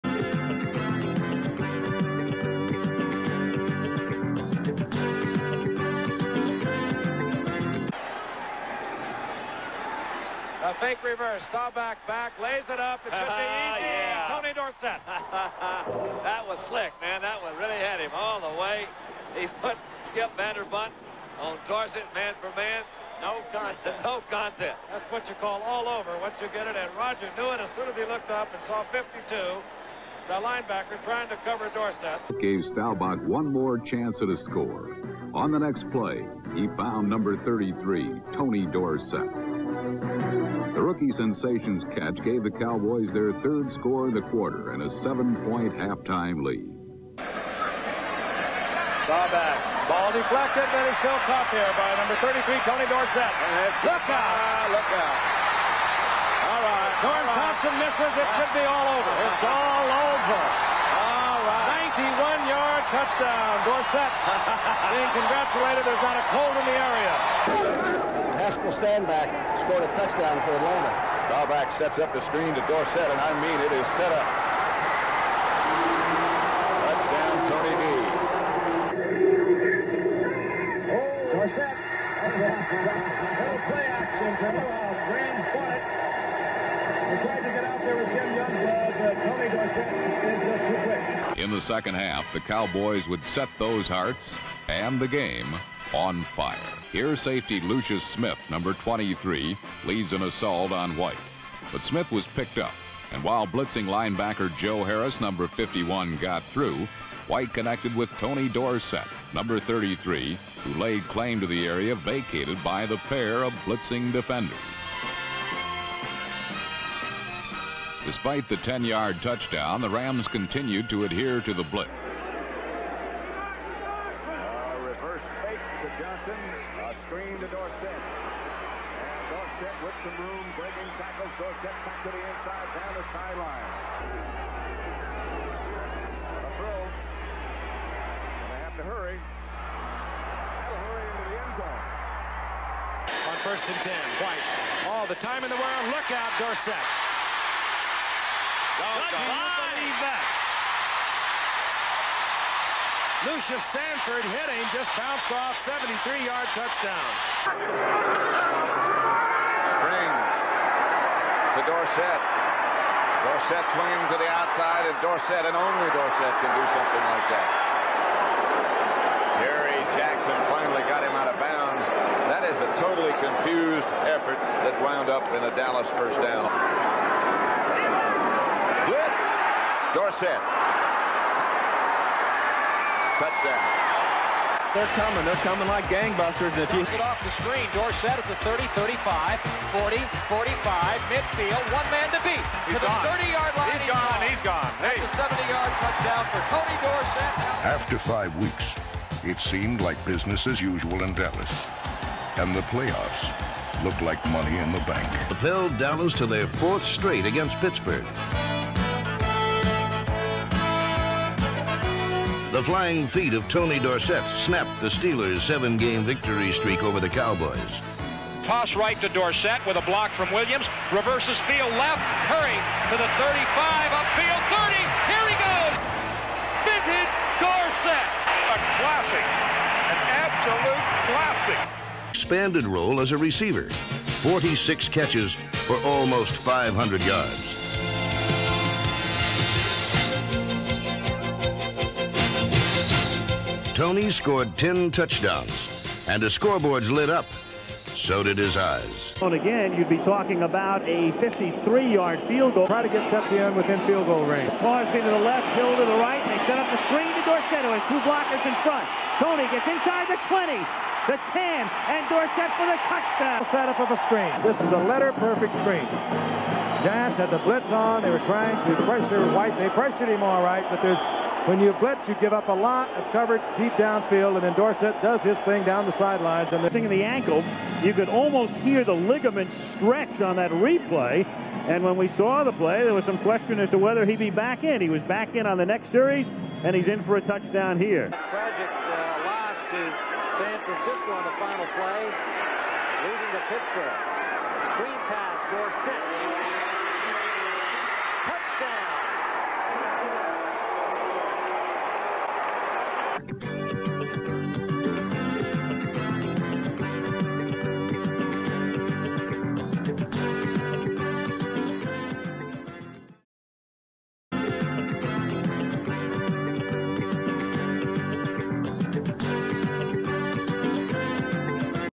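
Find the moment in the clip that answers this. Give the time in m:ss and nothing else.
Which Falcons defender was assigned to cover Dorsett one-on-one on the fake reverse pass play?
0:20.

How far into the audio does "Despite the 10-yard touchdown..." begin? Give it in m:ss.
1:58.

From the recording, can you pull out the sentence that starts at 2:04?
reverse fake to Johnson, a screen to Dorsett.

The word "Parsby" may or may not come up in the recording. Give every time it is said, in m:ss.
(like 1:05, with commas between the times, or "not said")
4:14.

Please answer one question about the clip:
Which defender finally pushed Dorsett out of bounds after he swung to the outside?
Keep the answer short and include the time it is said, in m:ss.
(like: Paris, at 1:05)
Jerry Jackson, at 2:49.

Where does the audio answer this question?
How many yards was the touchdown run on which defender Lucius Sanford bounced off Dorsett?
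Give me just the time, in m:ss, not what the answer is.
2:35.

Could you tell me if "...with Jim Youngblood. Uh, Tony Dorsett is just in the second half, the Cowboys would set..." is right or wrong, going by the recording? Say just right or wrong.
right.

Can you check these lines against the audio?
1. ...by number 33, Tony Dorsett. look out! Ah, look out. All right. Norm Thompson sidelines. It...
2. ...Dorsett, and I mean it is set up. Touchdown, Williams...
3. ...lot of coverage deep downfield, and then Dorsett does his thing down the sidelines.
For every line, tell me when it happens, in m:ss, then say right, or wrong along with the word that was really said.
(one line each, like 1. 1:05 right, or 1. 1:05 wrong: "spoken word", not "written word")
1. 0:51 wrong: "misses", not "sidelines"
2. 1:12 wrong: "Tony", not "Williams"
3. 4:32 right.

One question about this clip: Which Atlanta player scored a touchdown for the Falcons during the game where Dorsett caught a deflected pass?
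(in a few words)
Haskel Stanback.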